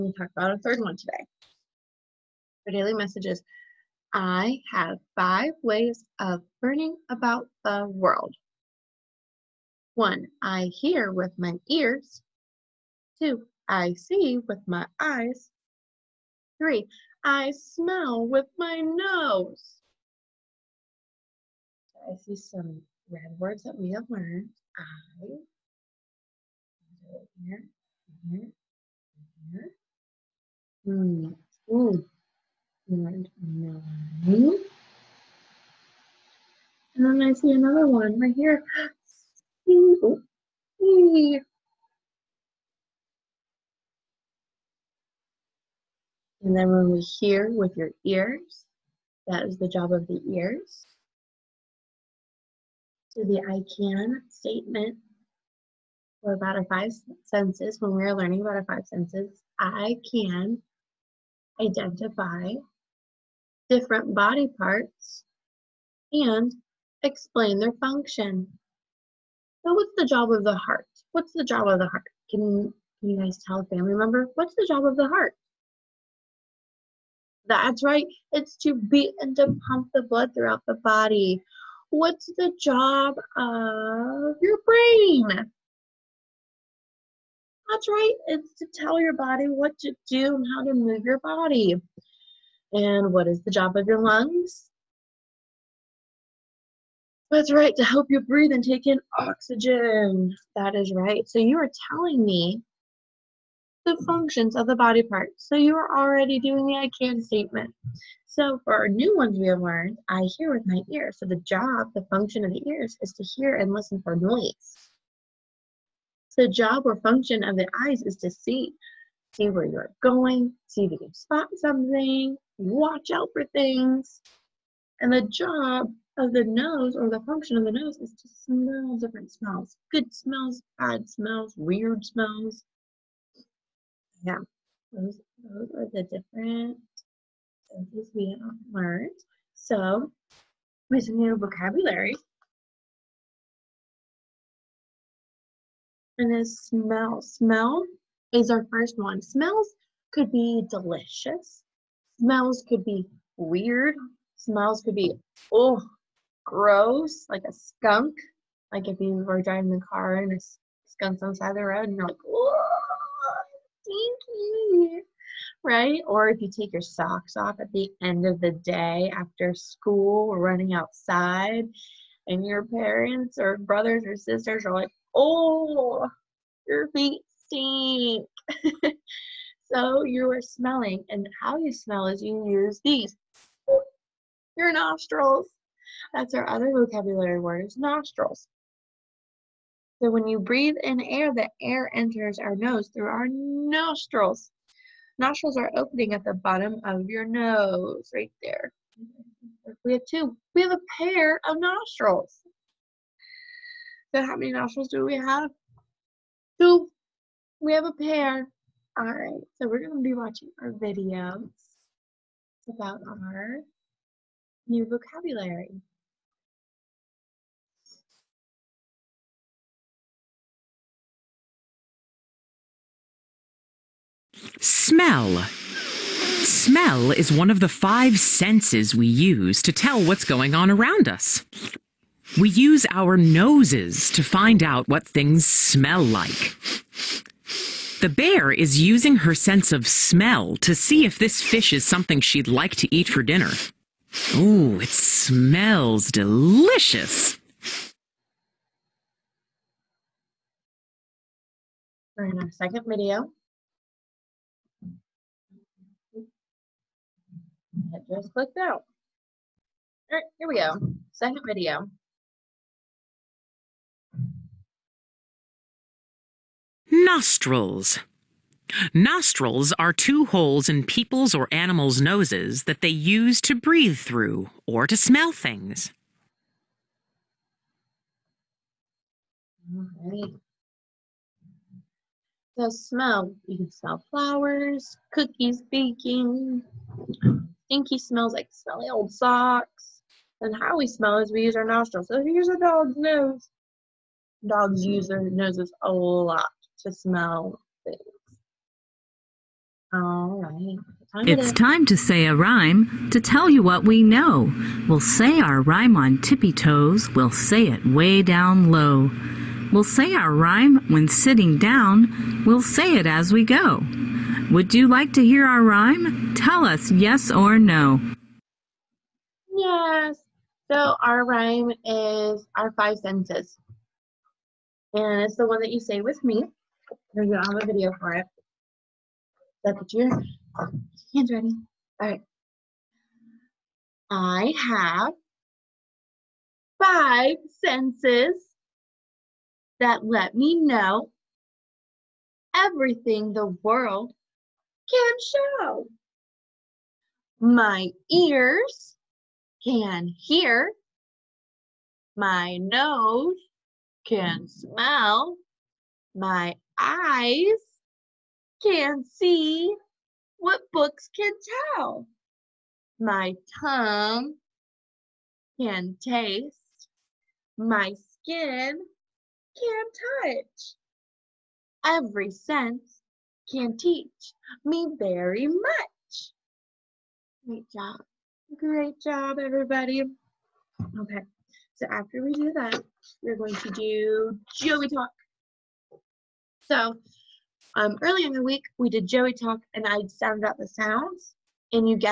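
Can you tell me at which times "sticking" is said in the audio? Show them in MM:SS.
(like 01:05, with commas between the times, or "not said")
not said.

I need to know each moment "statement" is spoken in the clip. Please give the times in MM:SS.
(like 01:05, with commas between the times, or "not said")
00:54, 01:47.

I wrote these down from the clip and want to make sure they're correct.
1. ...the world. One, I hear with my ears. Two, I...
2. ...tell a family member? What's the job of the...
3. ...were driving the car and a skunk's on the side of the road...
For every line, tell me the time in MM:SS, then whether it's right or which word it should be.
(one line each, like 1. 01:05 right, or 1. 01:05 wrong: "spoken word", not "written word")
1. 00:07 right
2. 01:13 right
3. 02:39 right.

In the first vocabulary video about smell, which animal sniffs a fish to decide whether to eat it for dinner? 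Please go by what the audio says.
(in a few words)
bear.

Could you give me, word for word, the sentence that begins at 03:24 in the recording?
So how many nostrils do we have?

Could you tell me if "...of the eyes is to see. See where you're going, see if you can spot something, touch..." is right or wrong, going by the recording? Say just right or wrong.
wrong.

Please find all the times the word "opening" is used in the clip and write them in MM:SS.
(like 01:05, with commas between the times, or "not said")
03:15.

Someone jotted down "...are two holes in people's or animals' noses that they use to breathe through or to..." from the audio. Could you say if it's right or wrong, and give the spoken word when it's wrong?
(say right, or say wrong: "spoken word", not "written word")
right.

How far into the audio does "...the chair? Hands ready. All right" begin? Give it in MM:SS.
05:29.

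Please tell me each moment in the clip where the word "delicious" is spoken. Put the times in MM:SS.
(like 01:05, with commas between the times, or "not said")
02:30, 04:06.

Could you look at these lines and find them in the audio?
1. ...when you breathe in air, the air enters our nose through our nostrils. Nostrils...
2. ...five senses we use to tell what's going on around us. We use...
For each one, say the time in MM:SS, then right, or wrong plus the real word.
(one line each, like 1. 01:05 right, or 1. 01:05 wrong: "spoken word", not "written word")
1. 03:10 right
2. 03:47 right.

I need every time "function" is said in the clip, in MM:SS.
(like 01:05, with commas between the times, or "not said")
01:07, 01:44, 01:52, 01:56, 02:07.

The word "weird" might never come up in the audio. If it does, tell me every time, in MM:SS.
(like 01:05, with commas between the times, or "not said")
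02:11, 02:33.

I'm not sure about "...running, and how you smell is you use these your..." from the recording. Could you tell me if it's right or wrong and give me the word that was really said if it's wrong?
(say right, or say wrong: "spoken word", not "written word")
wrong: "smelling", not "running".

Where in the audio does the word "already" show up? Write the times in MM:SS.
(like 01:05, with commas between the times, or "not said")
01:45.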